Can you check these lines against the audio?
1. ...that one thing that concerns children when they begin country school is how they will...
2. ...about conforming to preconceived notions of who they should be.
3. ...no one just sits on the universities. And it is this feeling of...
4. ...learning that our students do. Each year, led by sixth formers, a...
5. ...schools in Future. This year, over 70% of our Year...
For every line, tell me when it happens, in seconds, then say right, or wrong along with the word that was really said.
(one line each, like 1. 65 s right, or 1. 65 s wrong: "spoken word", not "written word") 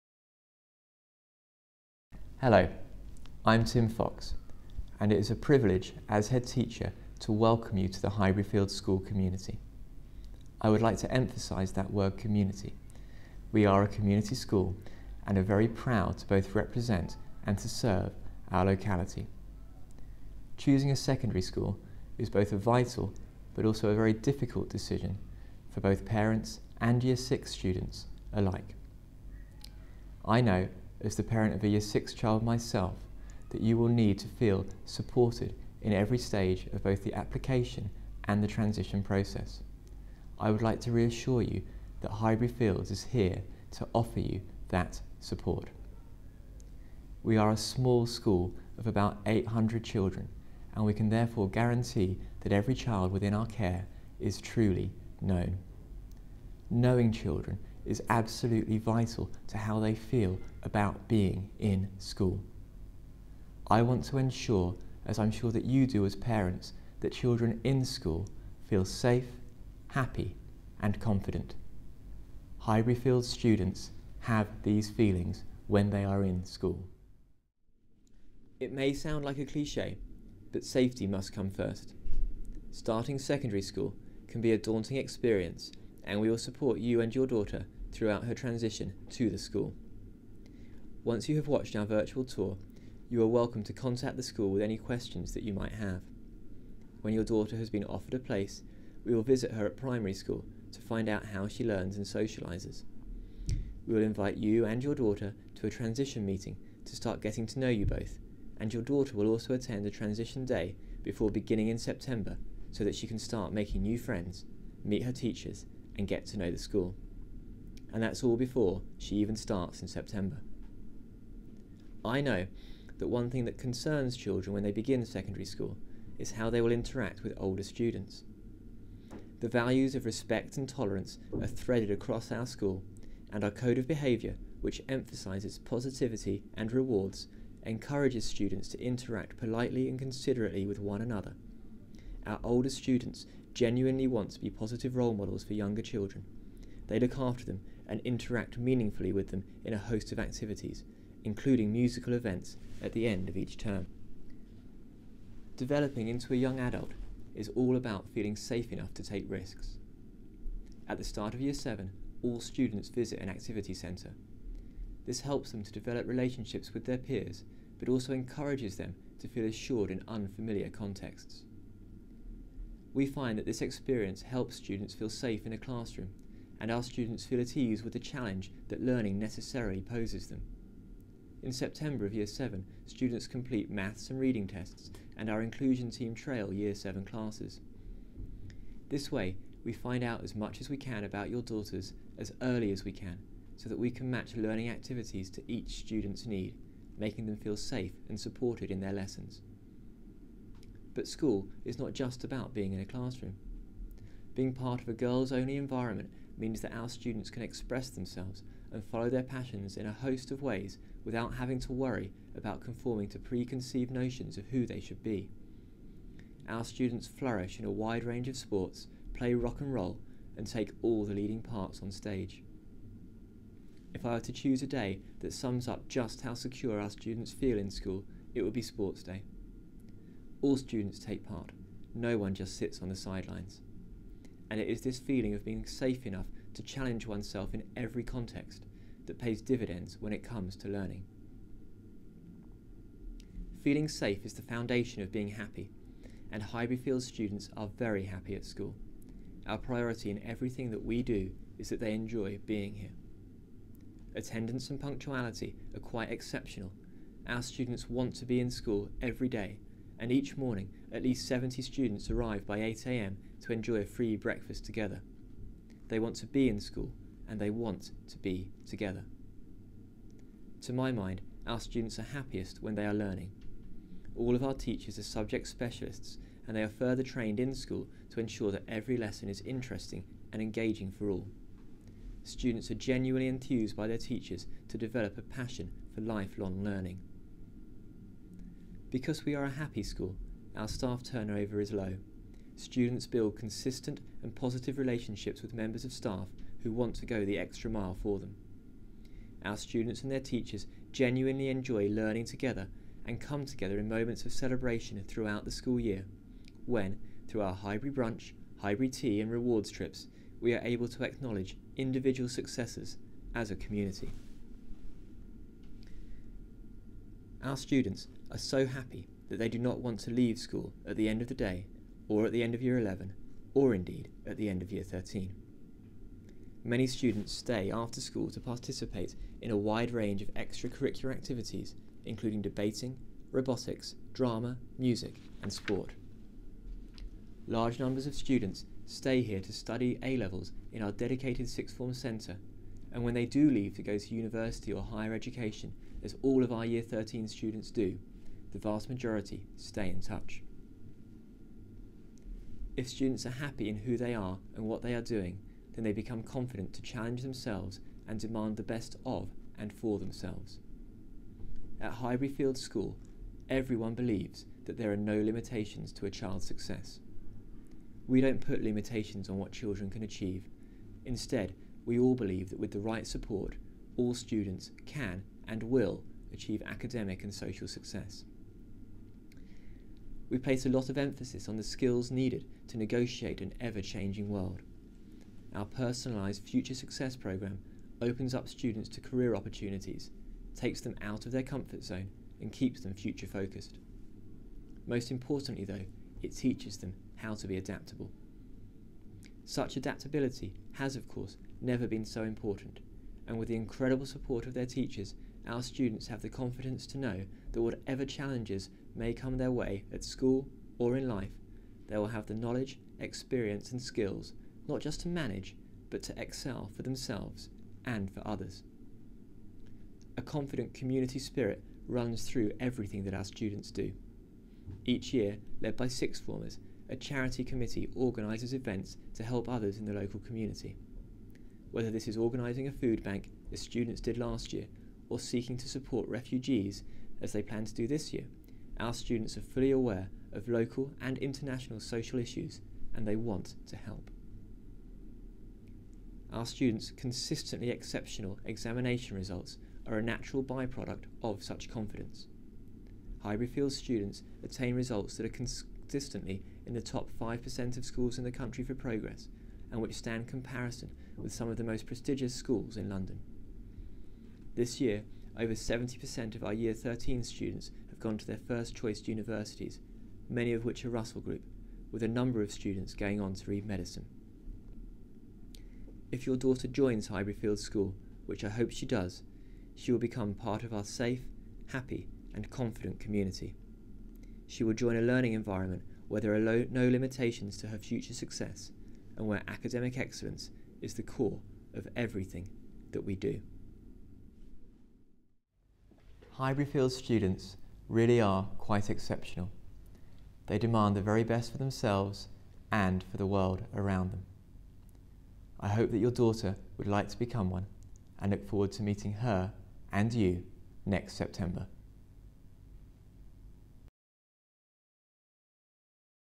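1. 122 s wrong: "secondary", not "country"
2. 212 s right
3. 231 s wrong: "sidelines", not "universities"
4. 422 s wrong: "everything", not "learning"
5. 462 s wrong: "London", not "Future".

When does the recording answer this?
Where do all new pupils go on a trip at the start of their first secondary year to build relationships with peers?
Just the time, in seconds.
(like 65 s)
163 s.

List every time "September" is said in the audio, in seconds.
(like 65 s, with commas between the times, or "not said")
111 s, 119 s, 181 s, 511 s.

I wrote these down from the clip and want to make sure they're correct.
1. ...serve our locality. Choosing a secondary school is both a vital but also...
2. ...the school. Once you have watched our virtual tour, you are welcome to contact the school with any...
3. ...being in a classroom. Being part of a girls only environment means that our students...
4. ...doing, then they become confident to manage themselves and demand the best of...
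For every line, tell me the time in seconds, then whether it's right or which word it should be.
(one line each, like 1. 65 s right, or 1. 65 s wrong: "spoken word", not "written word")
1. 17 s right
2. 89 s right
3. 202 s right
4. 355 s wrong: "challenge", not "manage".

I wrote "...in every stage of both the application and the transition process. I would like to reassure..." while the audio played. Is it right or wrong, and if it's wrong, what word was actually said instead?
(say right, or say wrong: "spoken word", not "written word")
right.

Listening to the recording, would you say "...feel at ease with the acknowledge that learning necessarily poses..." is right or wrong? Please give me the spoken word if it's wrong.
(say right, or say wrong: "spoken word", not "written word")
wrong: "challenge", not "acknowledge".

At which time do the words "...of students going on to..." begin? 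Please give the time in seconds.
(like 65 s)
472 s.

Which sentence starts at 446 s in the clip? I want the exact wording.
Our students' consistently exceptional examination results are a natural byproduct of such confidence.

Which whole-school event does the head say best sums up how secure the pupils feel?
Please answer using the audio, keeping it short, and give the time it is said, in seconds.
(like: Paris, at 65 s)
Sports Day, at 228 s.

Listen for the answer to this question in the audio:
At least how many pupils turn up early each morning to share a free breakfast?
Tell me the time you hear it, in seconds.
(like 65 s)
261 s.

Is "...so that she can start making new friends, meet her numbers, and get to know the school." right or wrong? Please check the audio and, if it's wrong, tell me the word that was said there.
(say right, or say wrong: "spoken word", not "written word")
wrong: "teachers", not "numbers".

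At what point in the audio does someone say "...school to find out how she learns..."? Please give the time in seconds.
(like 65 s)
100 s.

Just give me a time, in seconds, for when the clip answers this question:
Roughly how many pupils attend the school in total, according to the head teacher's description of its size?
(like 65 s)
49 s.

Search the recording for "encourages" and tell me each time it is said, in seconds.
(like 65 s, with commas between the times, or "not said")
137 s, 168 s.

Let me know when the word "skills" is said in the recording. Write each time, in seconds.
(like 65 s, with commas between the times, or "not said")
381 s, 413 s.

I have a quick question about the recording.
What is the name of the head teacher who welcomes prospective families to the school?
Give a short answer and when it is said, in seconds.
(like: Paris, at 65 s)
Tim Fox, at 3 s.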